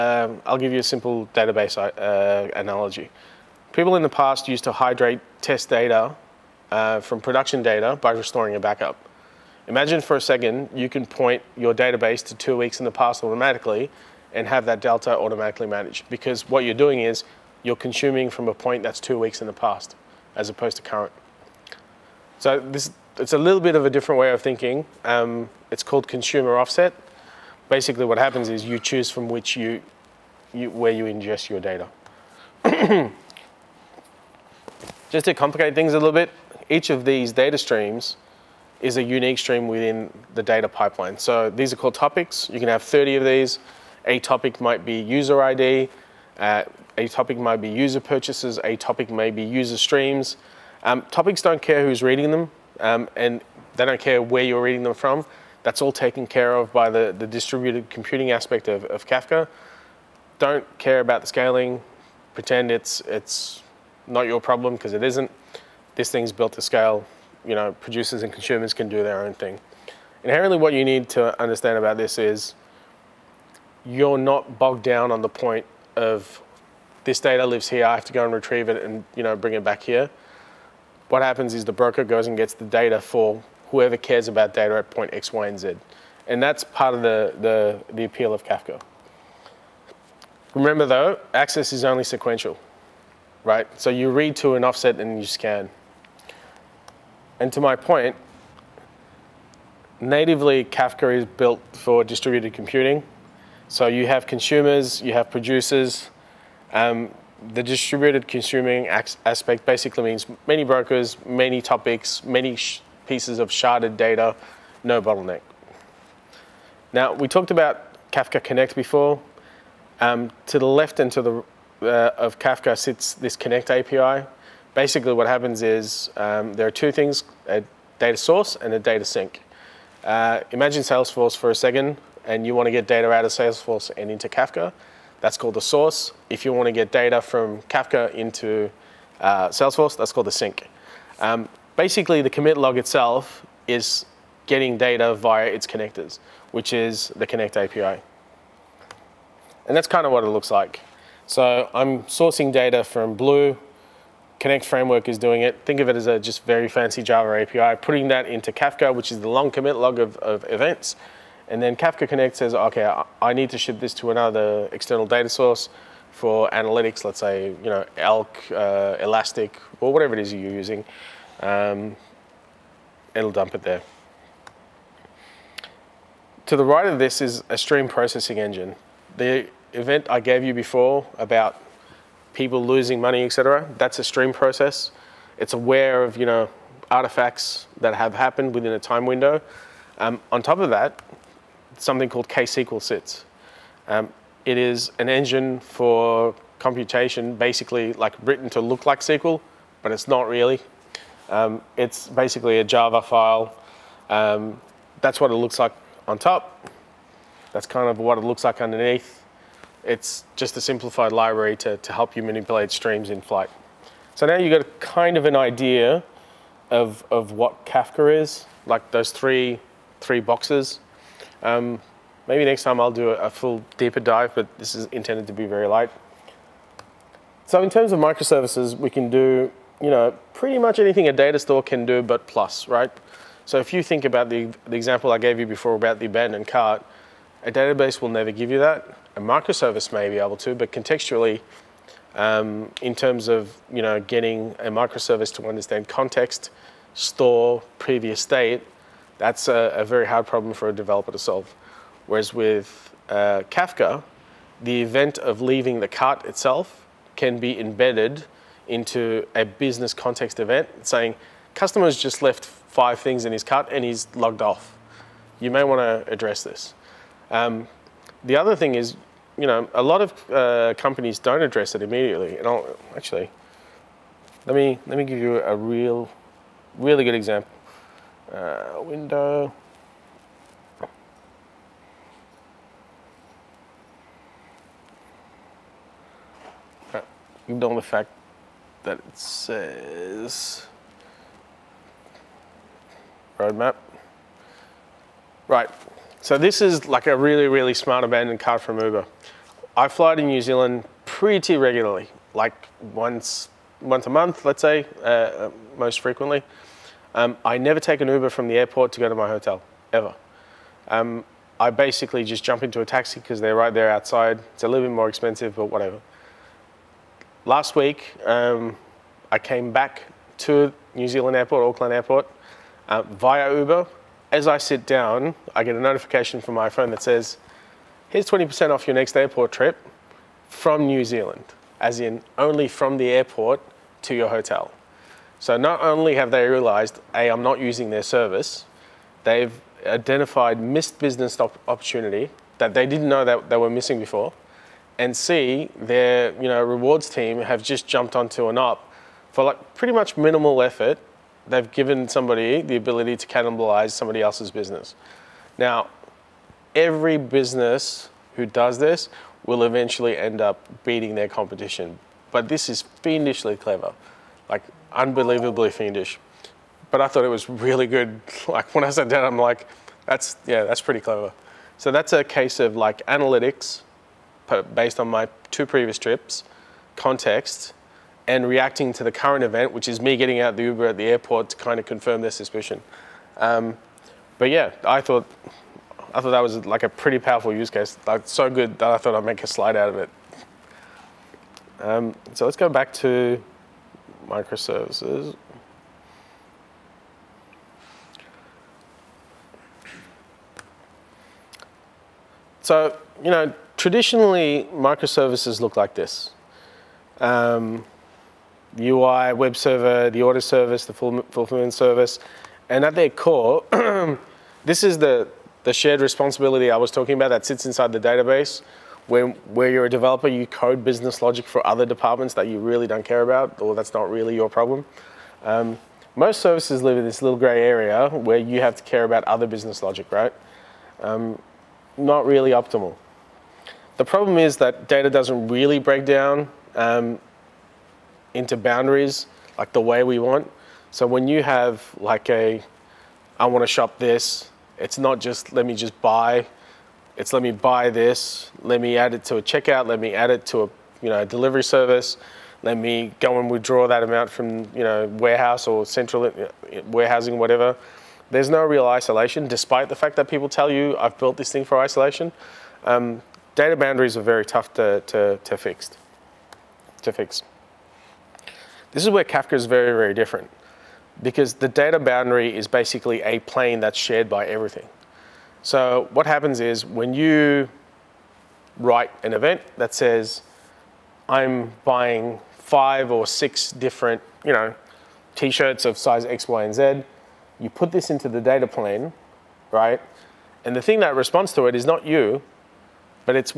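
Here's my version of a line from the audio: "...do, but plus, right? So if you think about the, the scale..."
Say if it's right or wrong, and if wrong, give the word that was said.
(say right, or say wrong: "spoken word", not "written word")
wrong: "example", not "scale".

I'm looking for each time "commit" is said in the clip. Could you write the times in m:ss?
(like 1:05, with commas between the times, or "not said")
2:22, 2:39.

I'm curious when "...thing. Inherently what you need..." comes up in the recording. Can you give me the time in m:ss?
1:09.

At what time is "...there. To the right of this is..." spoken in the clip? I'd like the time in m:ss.
2:53.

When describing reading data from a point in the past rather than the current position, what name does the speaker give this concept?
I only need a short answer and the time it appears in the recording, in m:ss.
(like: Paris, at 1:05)
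consumer offset, at 0:26.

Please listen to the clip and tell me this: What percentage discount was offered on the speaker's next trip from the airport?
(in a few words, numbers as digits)
20%.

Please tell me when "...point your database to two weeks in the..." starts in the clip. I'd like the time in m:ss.
0:11.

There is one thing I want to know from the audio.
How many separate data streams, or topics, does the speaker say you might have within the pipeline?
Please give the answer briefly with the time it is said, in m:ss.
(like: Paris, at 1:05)
30, at 0:42.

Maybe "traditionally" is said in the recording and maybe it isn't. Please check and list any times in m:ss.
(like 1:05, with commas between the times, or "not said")
6:43.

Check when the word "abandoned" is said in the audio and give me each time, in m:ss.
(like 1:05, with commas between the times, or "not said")
3:56, 4:58.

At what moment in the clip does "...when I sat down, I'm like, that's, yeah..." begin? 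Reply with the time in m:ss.
6:08.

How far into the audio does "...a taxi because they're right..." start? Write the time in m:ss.
5:12.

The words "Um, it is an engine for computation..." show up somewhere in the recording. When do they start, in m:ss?
3:13.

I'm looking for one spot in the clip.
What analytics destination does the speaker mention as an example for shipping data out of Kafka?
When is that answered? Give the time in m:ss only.
2:47.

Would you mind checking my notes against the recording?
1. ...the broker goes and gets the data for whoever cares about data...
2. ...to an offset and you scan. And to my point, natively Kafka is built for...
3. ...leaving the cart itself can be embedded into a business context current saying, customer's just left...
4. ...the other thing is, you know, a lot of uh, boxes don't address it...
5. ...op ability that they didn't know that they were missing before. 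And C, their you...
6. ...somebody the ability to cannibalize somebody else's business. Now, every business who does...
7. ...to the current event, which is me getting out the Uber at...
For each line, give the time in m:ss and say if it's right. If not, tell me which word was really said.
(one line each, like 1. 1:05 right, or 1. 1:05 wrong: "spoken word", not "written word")
1. 1:21 right
2. 1:34 right
3. 4:15 wrong: "event", not "current"
4. 4:28 wrong: "companies", not "boxes"
5. 5:41 wrong: "opportunity", not "ability"
6. 5:52 right
7. 6:18 right.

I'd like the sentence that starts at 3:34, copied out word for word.
So now you've got kind of an idea of, of what Kafka is, like those three, three boxes.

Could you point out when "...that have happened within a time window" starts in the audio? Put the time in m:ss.
3:07.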